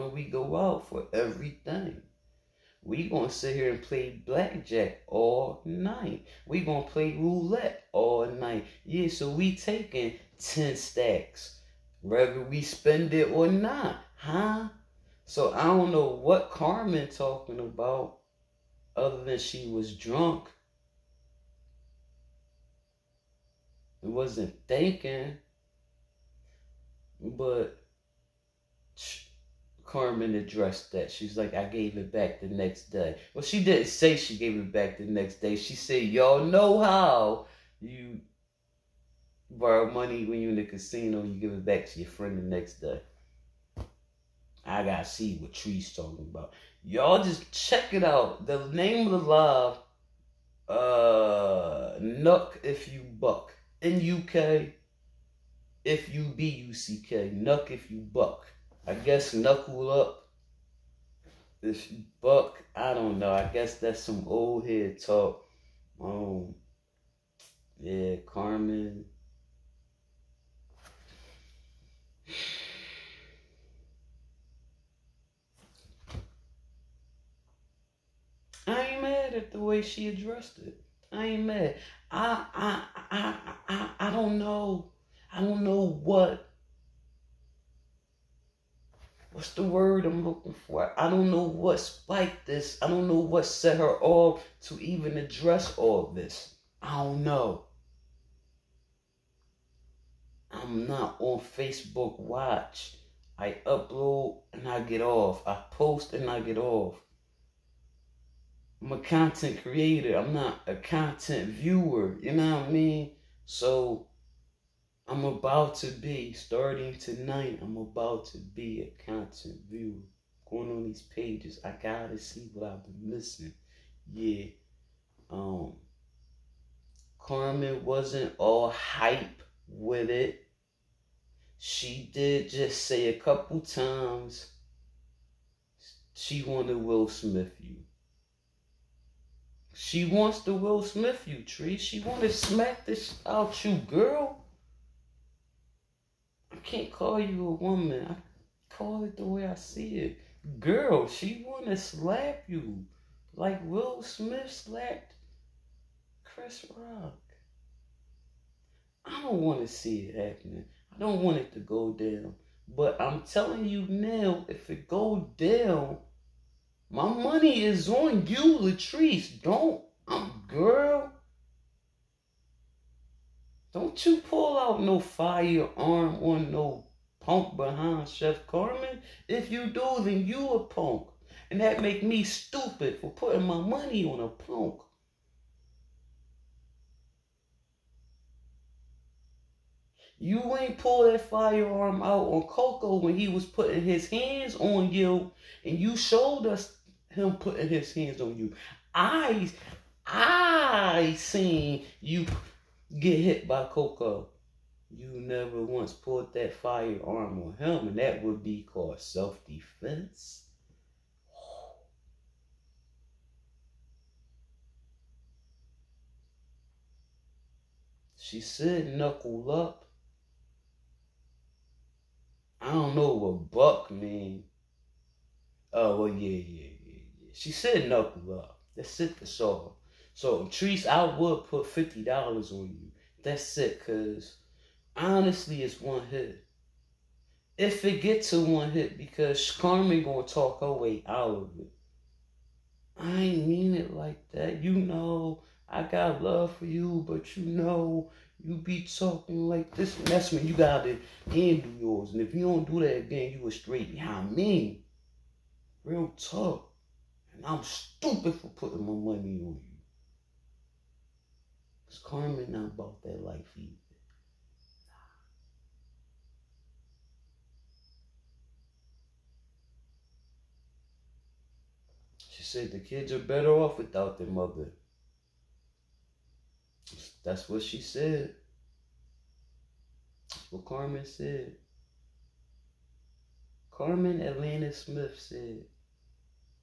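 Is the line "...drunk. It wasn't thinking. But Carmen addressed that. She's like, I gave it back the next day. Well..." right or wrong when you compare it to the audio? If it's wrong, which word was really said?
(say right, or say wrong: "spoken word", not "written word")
right.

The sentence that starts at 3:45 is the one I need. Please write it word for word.
Oh, well, yeah, yeah, yeah, yeah.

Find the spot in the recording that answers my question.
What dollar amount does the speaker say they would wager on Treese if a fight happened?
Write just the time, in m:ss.
3:51.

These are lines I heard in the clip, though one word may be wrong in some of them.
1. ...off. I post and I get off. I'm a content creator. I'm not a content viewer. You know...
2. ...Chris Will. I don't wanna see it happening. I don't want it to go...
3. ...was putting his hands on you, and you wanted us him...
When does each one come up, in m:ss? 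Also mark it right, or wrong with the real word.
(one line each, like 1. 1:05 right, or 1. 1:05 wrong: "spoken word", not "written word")
1. 1:45 right
2. 2:36 wrong: "Rock", not "Will"
3. 3:13 wrong: "showed", not "wanted".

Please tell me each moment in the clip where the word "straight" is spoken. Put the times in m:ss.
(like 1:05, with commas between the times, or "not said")
4:13.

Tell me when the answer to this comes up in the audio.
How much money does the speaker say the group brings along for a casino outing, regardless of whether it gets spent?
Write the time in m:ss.
0:10.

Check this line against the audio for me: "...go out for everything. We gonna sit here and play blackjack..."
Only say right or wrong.
right.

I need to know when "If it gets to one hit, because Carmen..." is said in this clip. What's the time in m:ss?
3:57.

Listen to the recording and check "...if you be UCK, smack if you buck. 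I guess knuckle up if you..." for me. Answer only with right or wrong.
wrong.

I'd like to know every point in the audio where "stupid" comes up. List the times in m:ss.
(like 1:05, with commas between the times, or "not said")
3:02, 4:17.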